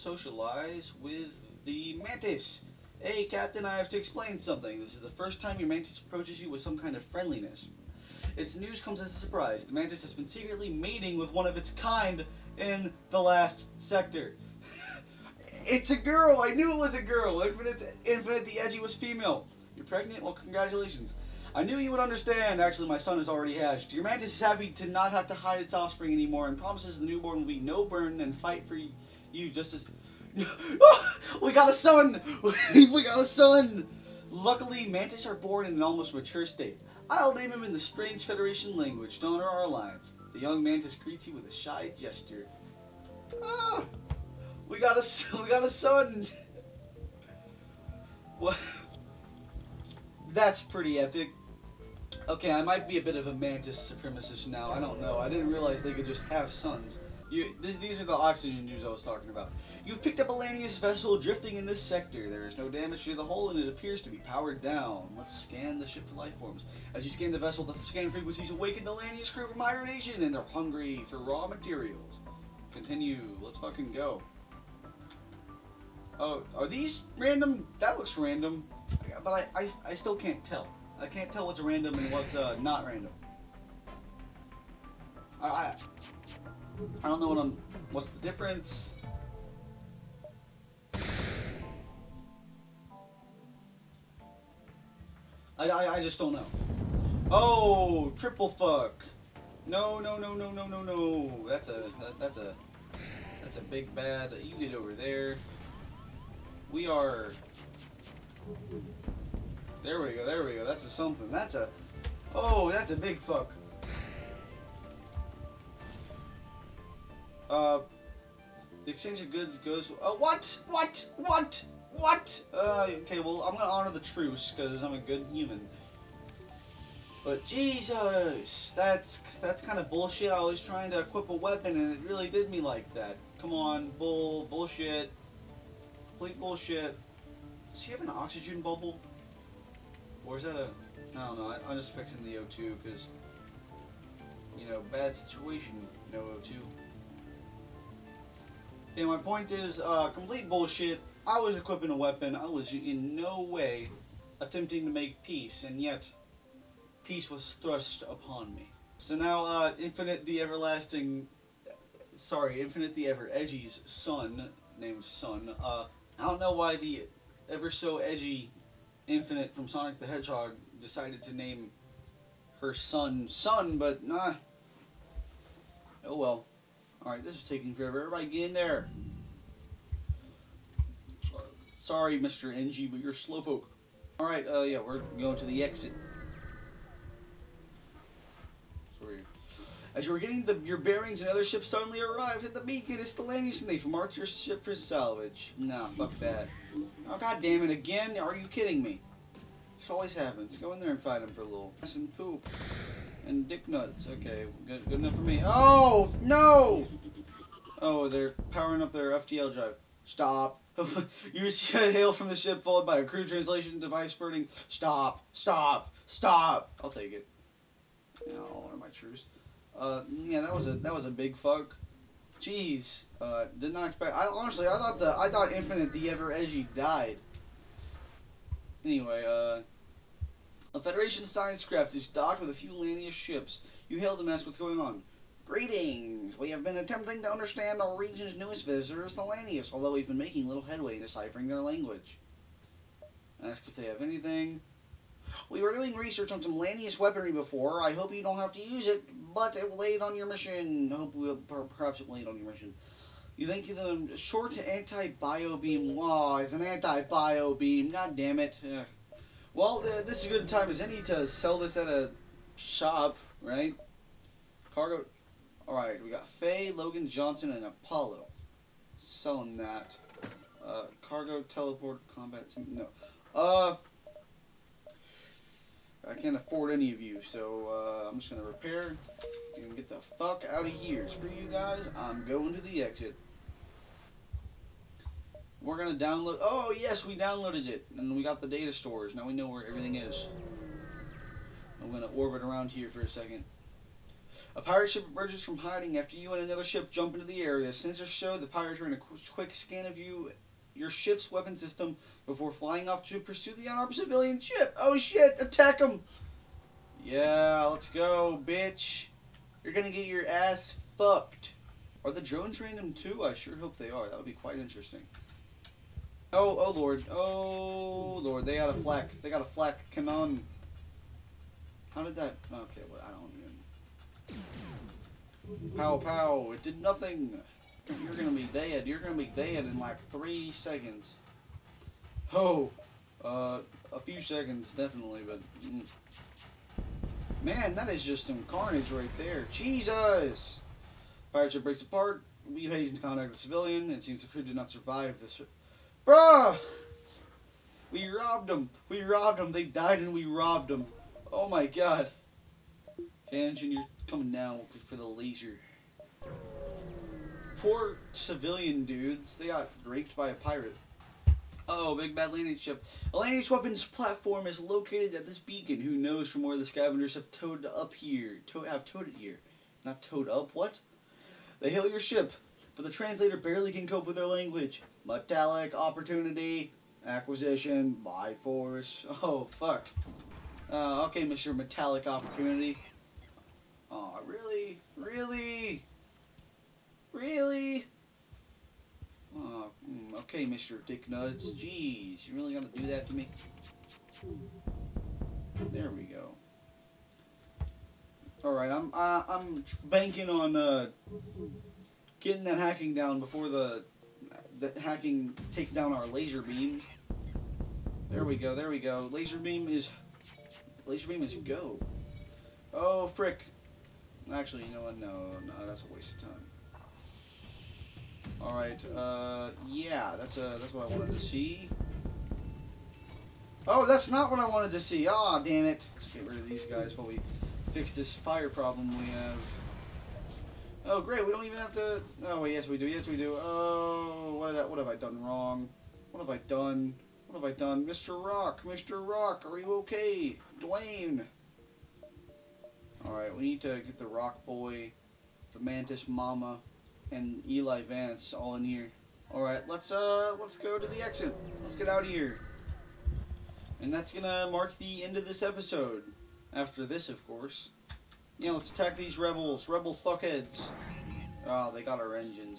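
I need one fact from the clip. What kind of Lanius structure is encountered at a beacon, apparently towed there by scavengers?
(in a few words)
Weapons platform.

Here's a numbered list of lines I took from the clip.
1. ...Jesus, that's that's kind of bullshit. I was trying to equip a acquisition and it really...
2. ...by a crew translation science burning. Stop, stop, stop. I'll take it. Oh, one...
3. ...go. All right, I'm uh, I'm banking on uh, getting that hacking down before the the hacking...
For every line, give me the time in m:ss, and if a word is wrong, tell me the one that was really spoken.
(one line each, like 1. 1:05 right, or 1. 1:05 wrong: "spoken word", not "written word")
1. 2:07 wrong: "weapon", not "acquisition"
2. 3:32 wrong: "device", not "science"
3. 6:36 right.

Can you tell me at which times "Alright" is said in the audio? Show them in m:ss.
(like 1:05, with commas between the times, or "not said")
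2:57, 3:04, 4:25.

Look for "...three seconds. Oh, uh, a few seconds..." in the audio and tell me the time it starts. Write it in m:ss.
5:30.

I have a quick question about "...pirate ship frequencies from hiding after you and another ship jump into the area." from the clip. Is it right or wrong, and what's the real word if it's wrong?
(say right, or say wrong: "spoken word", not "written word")
wrong: "emerges", not "frequencies".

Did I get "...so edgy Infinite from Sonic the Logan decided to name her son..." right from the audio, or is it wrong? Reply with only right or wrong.
wrong.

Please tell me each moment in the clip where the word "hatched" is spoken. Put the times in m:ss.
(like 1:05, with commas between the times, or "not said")
0:23.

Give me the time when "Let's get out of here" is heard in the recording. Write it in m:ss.
7:31.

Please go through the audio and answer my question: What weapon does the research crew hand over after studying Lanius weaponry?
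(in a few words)
Short anti-bio beam.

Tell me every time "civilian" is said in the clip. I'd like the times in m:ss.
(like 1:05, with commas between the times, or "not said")
5:03, 5:43, 5:58.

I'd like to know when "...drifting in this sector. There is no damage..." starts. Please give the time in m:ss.
1:01.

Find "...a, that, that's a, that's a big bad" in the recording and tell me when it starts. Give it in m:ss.
1:41.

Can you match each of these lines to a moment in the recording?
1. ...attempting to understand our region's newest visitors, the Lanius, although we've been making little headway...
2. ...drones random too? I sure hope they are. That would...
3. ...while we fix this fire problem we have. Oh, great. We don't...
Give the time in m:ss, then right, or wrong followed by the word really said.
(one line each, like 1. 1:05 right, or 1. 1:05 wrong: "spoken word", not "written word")
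1. 3:56 right
2. 5:12 right
3. 7:06 right.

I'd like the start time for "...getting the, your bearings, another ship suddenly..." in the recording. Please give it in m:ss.
3:10.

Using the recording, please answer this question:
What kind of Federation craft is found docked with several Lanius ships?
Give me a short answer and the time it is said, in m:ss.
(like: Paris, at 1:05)
Federation science craft, at 3:50.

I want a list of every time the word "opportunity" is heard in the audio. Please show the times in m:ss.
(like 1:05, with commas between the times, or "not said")
6:15, 6:22.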